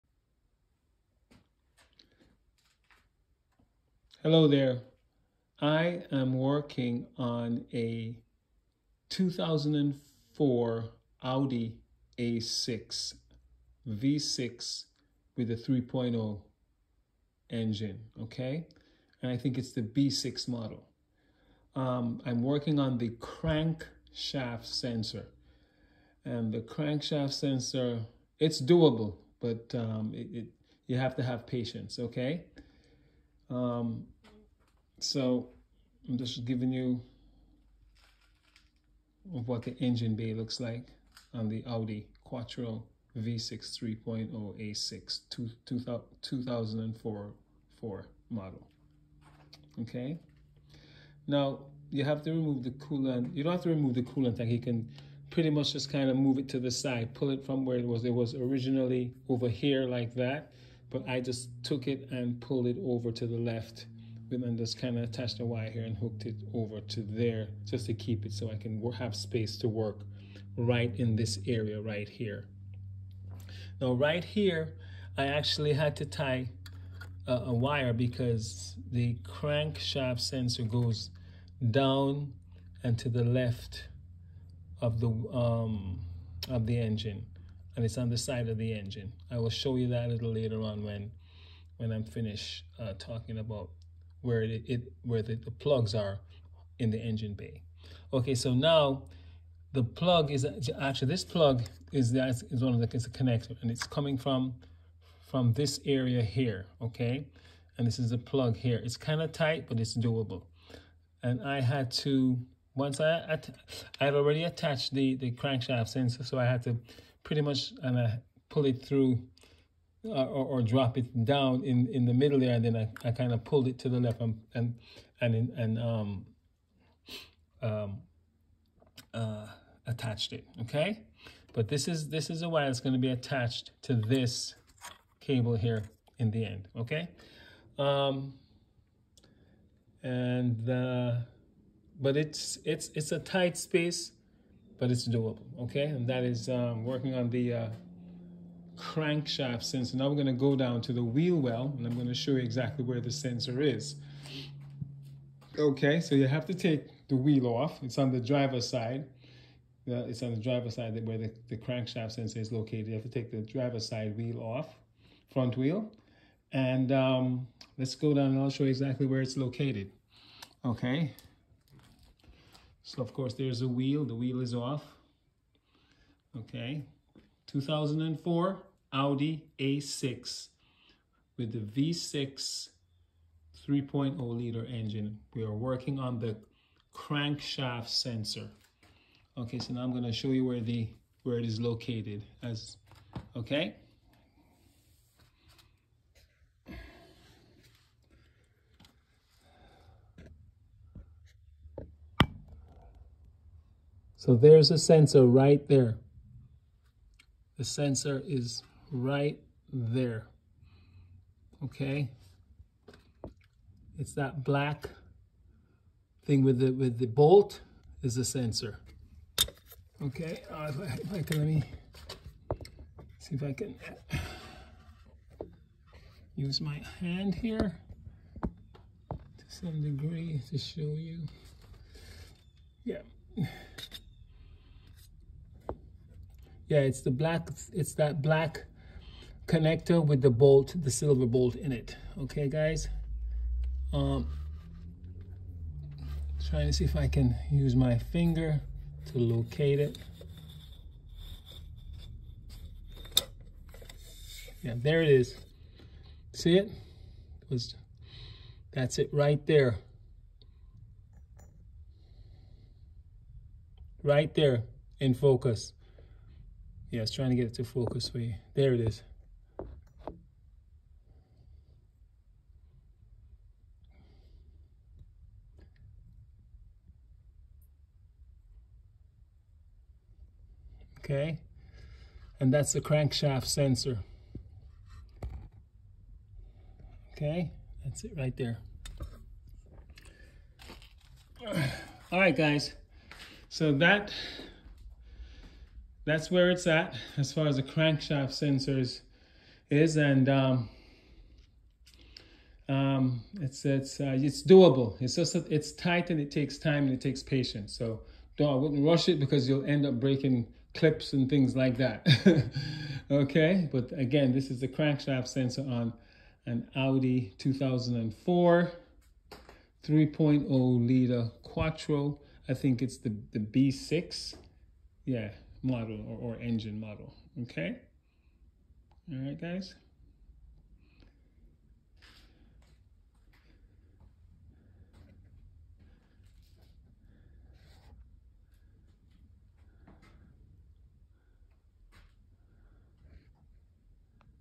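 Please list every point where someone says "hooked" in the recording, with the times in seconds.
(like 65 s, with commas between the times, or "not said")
65 s.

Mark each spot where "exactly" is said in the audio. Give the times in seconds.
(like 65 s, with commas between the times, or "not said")
152 s, 168 s.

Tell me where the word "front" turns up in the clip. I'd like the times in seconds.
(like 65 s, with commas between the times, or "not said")
165 s.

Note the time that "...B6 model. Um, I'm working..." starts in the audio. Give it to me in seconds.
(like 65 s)
19 s.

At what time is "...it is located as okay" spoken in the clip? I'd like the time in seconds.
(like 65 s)
191 s.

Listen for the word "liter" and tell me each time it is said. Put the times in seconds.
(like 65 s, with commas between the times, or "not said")
184 s, 320 s.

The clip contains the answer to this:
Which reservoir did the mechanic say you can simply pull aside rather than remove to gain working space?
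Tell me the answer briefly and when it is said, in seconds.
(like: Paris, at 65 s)
coolant tank, at 54 s.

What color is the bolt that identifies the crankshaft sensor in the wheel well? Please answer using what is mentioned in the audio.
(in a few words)
silver.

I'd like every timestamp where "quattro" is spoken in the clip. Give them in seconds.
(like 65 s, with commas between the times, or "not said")
42 s, 321 s.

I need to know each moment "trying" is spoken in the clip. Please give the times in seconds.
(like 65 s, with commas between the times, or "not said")
246 s, 267 s.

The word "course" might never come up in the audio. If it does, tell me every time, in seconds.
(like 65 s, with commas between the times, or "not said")
173 s.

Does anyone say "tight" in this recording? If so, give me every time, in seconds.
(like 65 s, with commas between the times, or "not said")
109 s, 143 s, 305 s.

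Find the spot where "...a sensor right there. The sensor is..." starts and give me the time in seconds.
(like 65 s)
204 s.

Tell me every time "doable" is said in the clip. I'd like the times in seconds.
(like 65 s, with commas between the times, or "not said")
28 s, 109 s, 145 s, 304 s.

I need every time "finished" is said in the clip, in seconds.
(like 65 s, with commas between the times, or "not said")
92 s.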